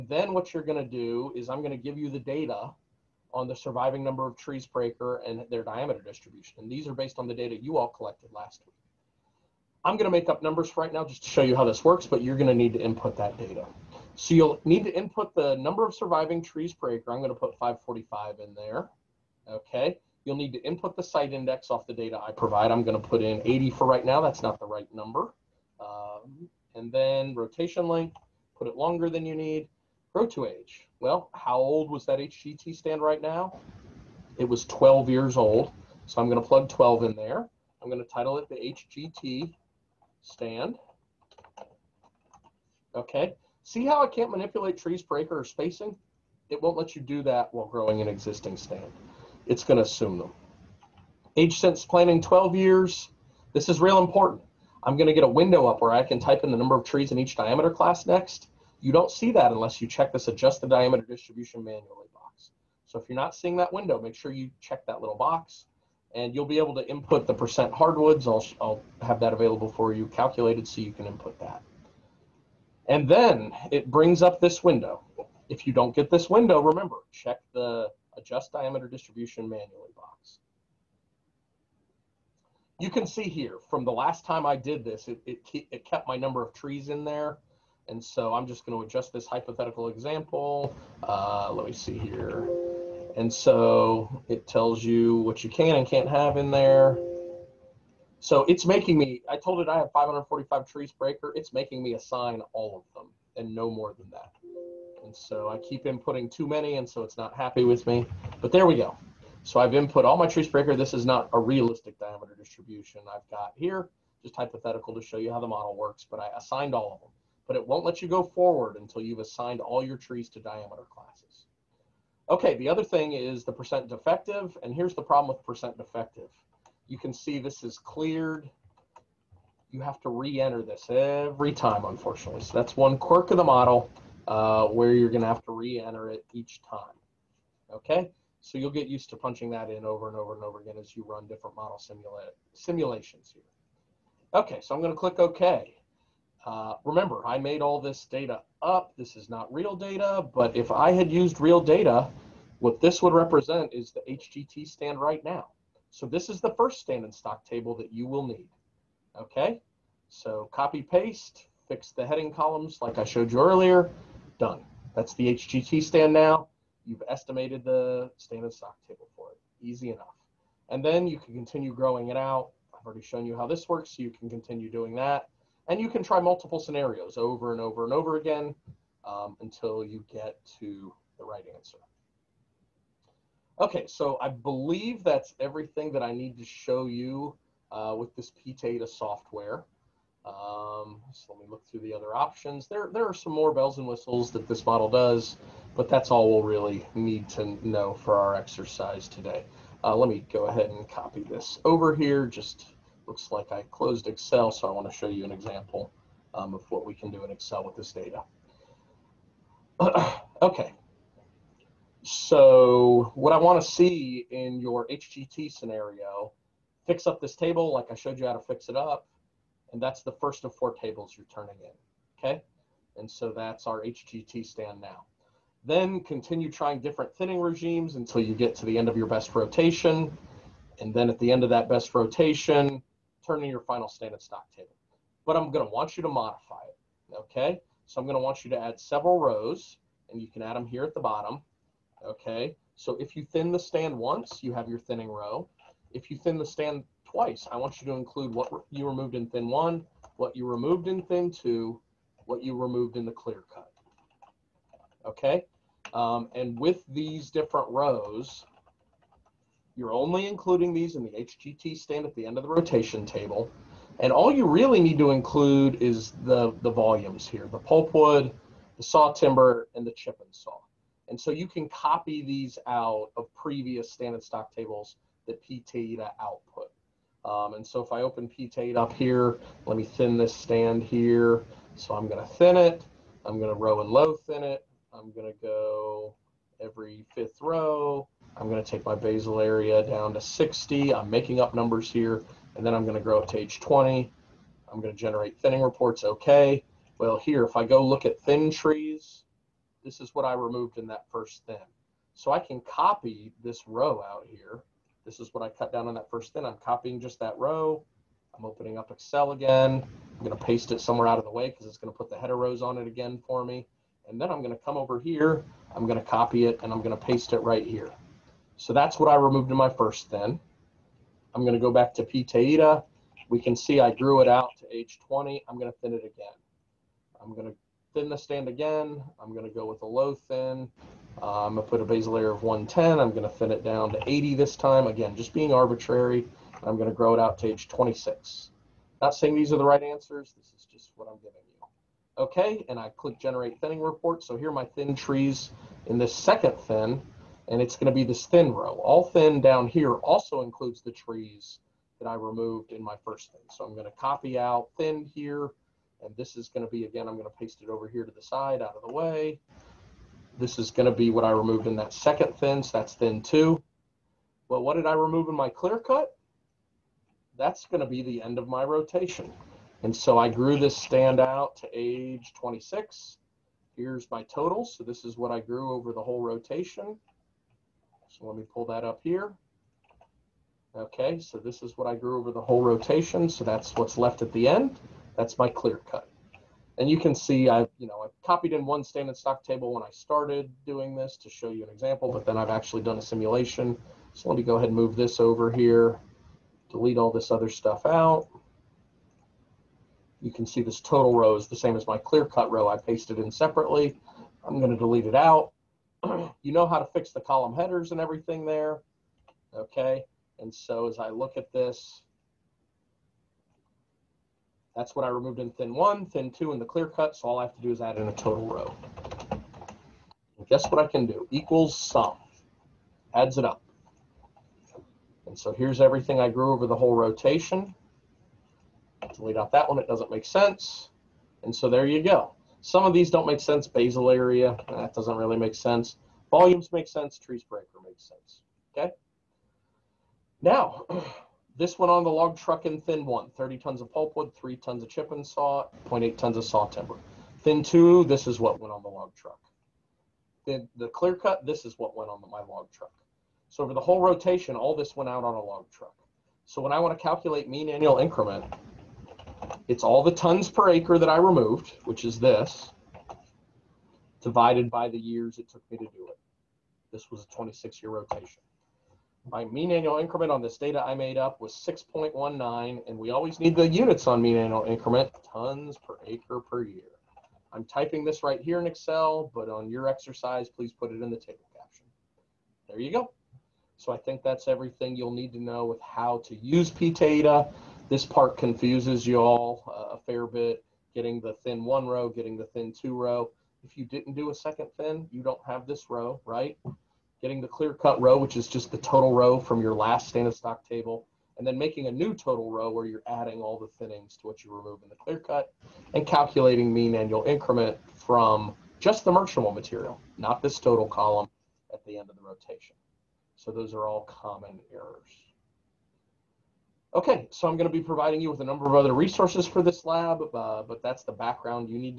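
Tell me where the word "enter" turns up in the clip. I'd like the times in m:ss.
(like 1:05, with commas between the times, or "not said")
2:10, 2:15.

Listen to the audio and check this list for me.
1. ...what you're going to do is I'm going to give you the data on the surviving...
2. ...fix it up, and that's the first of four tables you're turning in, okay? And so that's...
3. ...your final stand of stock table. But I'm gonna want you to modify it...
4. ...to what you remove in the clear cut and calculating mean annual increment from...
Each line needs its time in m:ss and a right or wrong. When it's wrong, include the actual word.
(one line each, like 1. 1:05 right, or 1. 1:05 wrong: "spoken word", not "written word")
1. 0:00 right
2. 3:38 right
3. 3:53 right
4. 8:24 right.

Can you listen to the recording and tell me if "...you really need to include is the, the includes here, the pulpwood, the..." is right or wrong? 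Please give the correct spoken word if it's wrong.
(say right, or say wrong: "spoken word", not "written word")
wrong: "volumes", not "includes".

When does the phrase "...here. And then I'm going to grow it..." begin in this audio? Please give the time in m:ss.
4:51.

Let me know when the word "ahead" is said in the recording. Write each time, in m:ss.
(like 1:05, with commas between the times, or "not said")
3:20, 6:34.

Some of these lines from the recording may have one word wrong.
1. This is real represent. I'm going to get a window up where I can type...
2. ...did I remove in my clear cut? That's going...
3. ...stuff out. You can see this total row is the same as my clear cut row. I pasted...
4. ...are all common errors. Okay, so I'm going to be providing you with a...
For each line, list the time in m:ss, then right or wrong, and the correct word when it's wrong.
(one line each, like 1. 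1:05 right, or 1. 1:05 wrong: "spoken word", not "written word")
1. 0:53 wrong: "important", not "represent"
2. 6:04 right
3. 6:37 right
4. 8:33 right.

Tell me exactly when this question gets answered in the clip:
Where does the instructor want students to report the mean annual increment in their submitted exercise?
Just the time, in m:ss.
8:01.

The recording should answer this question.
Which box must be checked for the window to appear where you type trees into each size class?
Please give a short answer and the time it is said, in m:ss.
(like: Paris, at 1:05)
adjust the diameter distribution manually, at 1:00.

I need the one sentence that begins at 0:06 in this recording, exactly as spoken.
And these are based on the data you all collected last week.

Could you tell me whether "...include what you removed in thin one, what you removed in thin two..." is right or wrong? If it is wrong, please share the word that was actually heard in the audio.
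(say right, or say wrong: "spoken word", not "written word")
right.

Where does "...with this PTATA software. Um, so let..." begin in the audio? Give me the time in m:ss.
3:07.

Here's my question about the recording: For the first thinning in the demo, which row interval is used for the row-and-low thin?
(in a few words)
every fifth row.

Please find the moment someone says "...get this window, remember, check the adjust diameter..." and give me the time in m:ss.
1:15.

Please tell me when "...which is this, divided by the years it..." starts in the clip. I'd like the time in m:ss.
7:41.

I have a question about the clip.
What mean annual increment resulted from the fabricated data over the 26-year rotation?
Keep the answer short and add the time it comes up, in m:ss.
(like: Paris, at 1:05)
6.19, at 7:51.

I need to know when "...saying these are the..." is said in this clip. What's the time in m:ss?
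5:39.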